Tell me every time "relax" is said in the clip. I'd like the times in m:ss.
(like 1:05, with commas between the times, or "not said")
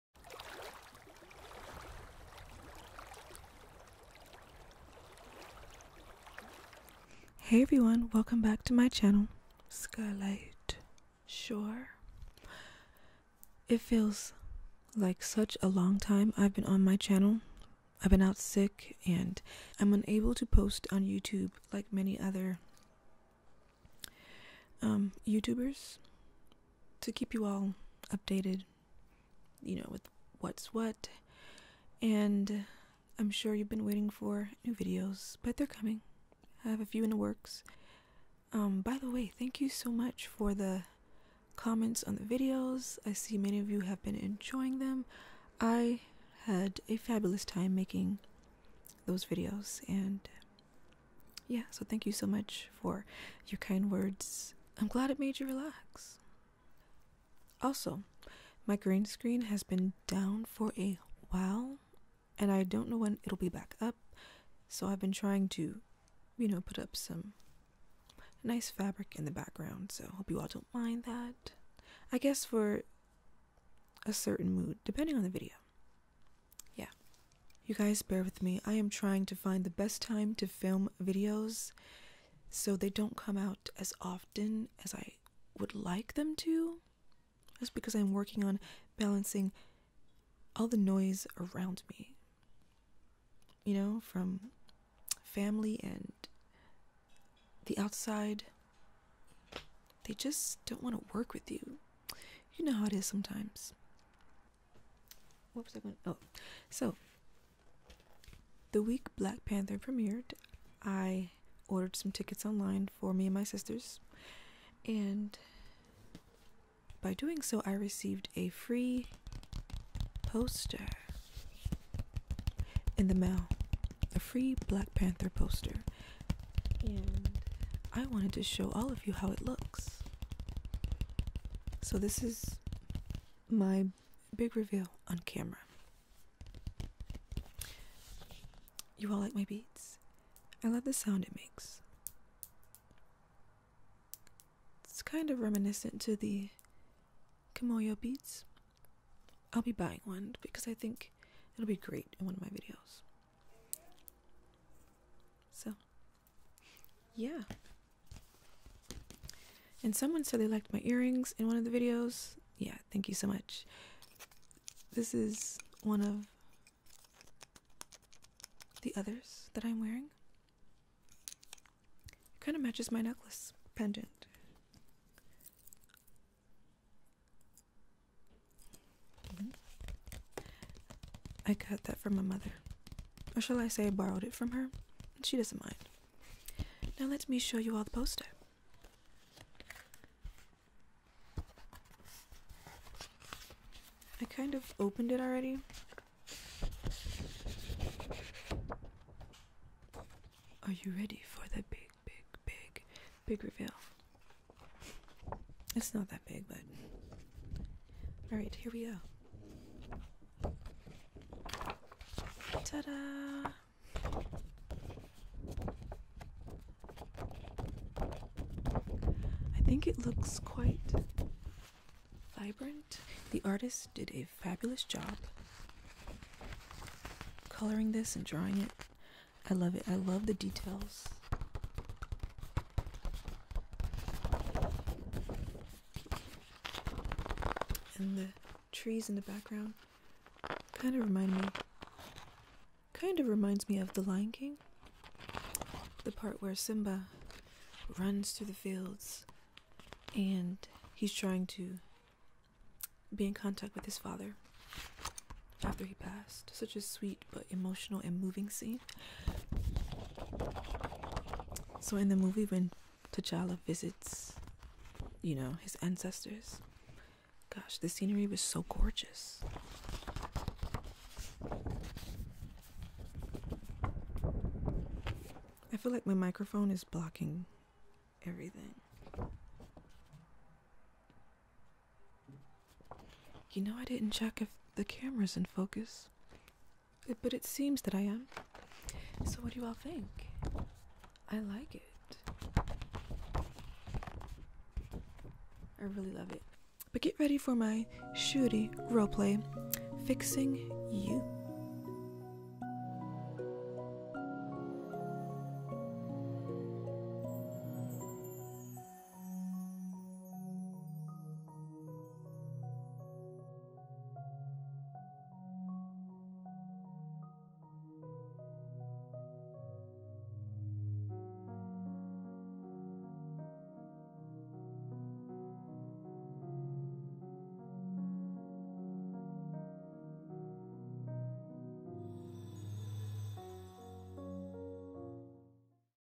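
0:55.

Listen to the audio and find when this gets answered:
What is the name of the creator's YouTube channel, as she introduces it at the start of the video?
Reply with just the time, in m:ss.
0:09.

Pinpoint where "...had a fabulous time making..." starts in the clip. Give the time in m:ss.
0:46.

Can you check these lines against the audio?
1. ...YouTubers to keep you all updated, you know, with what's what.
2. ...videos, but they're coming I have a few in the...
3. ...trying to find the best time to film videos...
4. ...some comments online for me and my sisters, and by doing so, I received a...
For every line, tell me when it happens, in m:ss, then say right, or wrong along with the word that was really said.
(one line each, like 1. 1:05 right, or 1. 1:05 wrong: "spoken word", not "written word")
1. 0:25 right
2. 0:34 right
3. 1:18 right
4. 1:51 wrong: "tickets", not "comments".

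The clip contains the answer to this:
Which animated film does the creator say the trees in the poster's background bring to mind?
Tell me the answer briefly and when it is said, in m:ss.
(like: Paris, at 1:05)
The Lion King, at 4:03.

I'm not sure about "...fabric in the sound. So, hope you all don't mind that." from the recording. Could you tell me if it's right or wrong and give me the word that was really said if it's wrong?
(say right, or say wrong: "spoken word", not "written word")
wrong: "background", not "sound".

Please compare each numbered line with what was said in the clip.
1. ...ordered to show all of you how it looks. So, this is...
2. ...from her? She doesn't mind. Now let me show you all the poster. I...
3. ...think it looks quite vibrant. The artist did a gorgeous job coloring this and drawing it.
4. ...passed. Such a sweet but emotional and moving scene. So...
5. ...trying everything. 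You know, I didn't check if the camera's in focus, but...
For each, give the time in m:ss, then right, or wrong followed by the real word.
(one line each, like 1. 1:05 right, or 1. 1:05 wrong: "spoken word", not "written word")
1. 2:08 wrong: "wanted", not "ordered"
2. 3:04 right
3. 3:39 wrong: "fabulous", not "gorgeous"
4. 4:15 right
5. 4:36 wrong: "blocking", not "trying".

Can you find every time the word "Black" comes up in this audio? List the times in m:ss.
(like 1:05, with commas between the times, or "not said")
1:49, 2:04.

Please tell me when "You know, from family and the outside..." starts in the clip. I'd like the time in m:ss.
1:33.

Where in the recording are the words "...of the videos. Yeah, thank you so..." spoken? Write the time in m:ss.
2:41.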